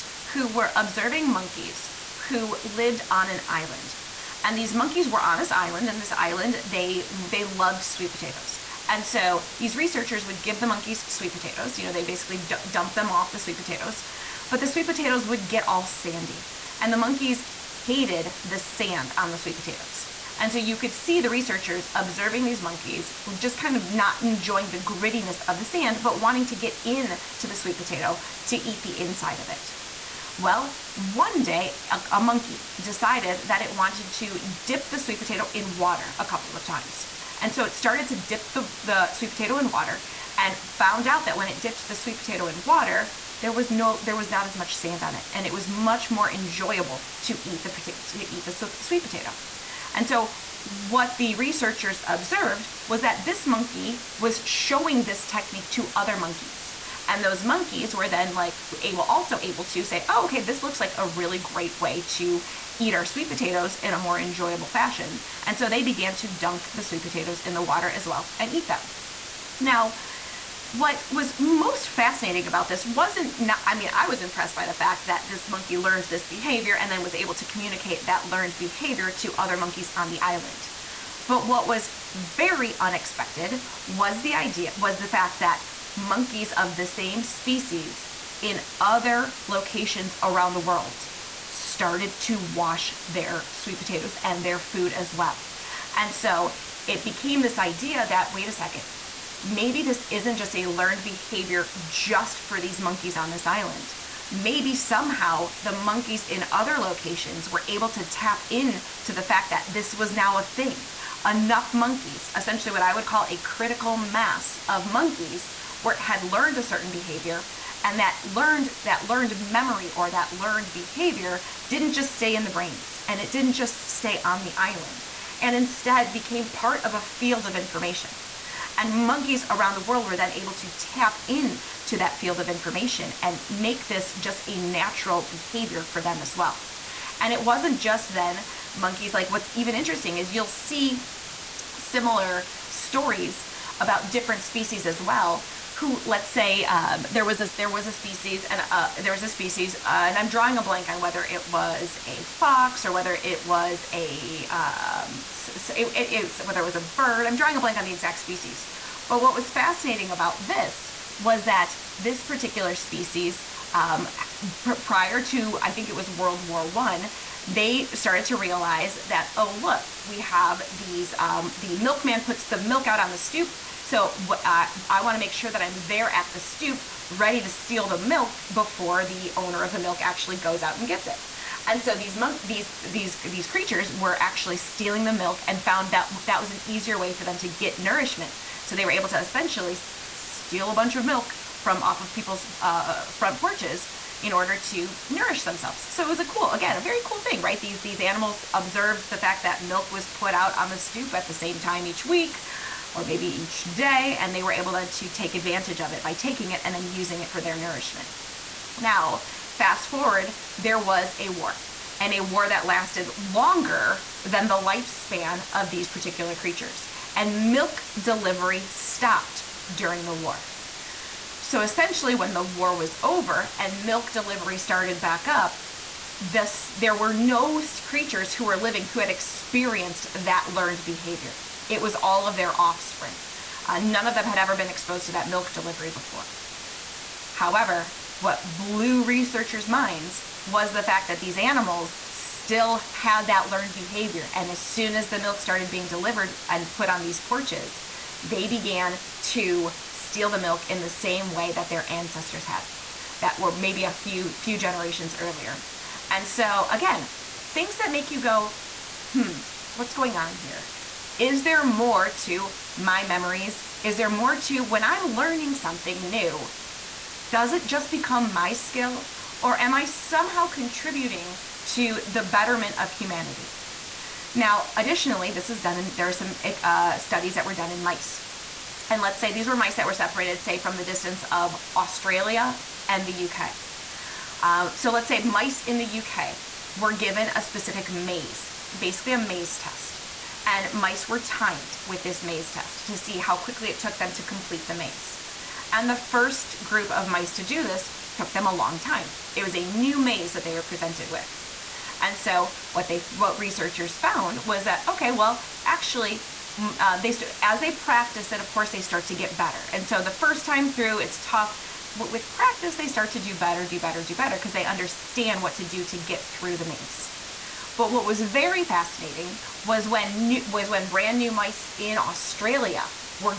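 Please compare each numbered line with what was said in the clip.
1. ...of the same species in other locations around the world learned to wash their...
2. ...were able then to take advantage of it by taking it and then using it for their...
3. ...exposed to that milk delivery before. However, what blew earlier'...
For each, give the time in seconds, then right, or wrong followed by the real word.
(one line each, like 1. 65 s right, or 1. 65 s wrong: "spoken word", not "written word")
1. 86 s wrong: "started", not "learned"
2. 204 s right
3. 234 s wrong: "researchers", not "earlier".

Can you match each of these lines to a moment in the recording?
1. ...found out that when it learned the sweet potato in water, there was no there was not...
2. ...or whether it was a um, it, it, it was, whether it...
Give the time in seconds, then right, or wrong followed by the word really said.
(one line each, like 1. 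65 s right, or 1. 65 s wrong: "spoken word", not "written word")
1. 40 s wrong: "dipped", not "learned"
2. 152 s right.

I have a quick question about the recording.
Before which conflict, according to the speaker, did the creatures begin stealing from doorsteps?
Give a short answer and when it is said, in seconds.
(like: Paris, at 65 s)
World War One, at 166 s.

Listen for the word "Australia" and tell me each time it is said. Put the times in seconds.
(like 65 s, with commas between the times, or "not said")
281 s, 321 s.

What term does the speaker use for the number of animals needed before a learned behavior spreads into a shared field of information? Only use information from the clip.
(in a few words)
Critical mass.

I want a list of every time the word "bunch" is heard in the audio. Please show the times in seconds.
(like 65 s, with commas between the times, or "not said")
190 s.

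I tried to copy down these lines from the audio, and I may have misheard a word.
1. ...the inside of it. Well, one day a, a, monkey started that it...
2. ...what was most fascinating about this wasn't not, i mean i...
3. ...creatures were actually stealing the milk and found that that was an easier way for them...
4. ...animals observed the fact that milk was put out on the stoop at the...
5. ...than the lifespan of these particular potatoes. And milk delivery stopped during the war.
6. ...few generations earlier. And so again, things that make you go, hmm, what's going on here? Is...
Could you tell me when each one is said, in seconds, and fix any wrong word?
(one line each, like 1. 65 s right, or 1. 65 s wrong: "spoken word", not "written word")
1. 28 s wrong: "decided", not "started"
2. 70 s right
3. 183 s right
4. 197 s right
5. 214 s wrong: "creatures", not "potatoes"
6. 254 s right.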